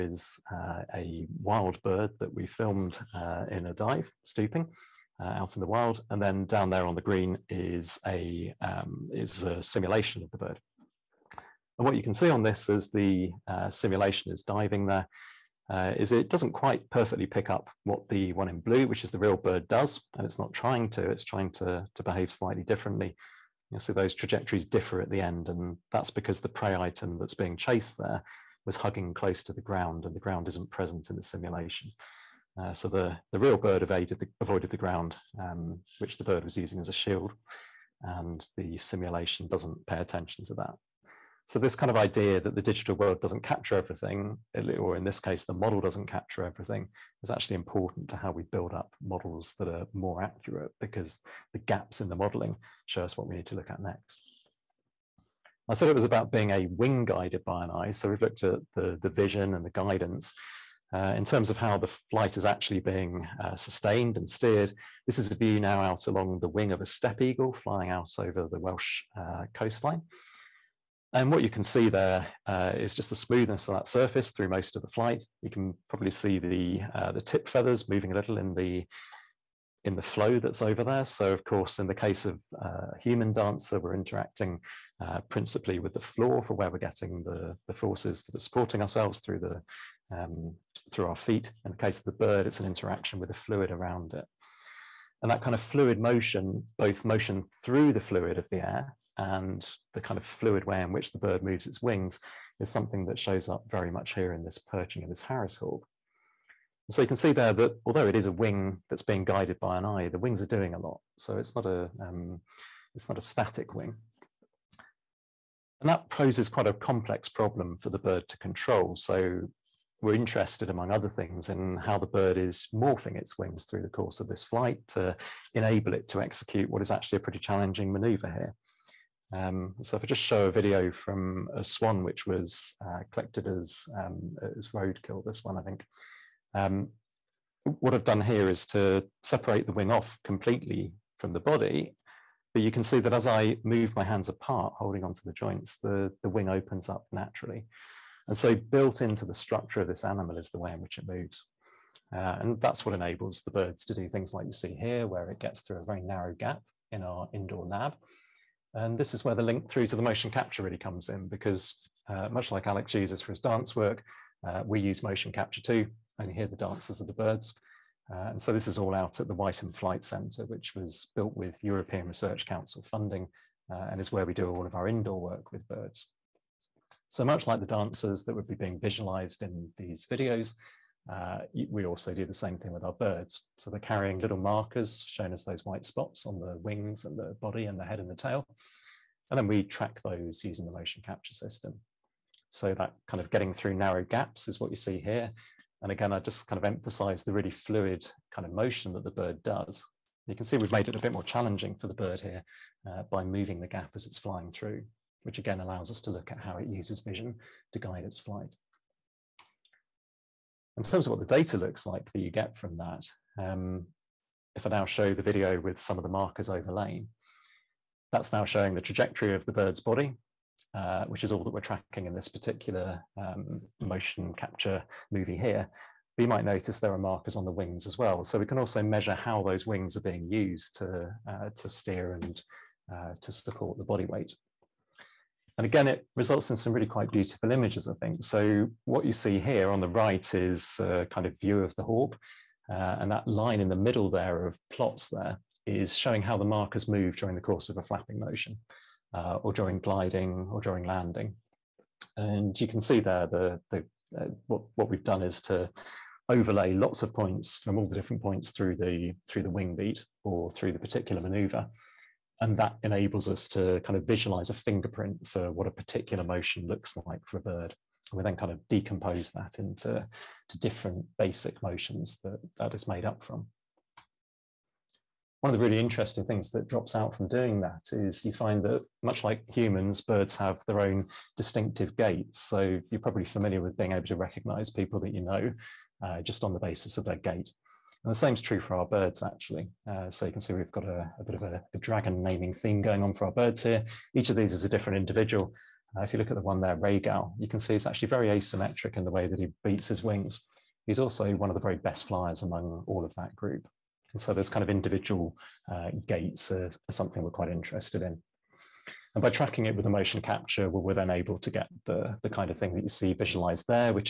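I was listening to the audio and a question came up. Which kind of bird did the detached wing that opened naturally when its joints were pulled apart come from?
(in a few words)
Swan.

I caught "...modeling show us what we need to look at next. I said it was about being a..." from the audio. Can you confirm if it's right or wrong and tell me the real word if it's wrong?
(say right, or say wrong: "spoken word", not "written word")
right.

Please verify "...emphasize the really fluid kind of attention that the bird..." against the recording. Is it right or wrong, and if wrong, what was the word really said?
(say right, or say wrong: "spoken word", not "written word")
wrong: "motion", not "attention".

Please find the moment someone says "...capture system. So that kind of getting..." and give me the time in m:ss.
3:11.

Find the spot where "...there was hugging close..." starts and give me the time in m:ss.
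0:27.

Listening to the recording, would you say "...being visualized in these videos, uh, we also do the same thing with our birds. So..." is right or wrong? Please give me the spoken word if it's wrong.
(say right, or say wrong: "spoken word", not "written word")
right.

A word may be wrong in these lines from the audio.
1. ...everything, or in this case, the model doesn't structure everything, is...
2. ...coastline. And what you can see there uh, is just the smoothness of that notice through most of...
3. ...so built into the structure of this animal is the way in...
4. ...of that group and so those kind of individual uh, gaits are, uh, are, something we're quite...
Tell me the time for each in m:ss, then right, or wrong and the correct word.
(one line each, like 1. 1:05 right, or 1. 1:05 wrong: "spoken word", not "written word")
1. 0:43 wrong: "capture", not "structure"
2. 1:09 wrong: "surface", not "notice"
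3. 2:28 right
4. 5:03 right.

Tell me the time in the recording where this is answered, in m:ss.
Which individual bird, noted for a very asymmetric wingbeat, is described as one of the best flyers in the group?
4:56.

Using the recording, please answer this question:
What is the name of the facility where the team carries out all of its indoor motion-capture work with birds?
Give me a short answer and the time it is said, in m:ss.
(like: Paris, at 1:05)
Wytham Flight Centre, at 2:49.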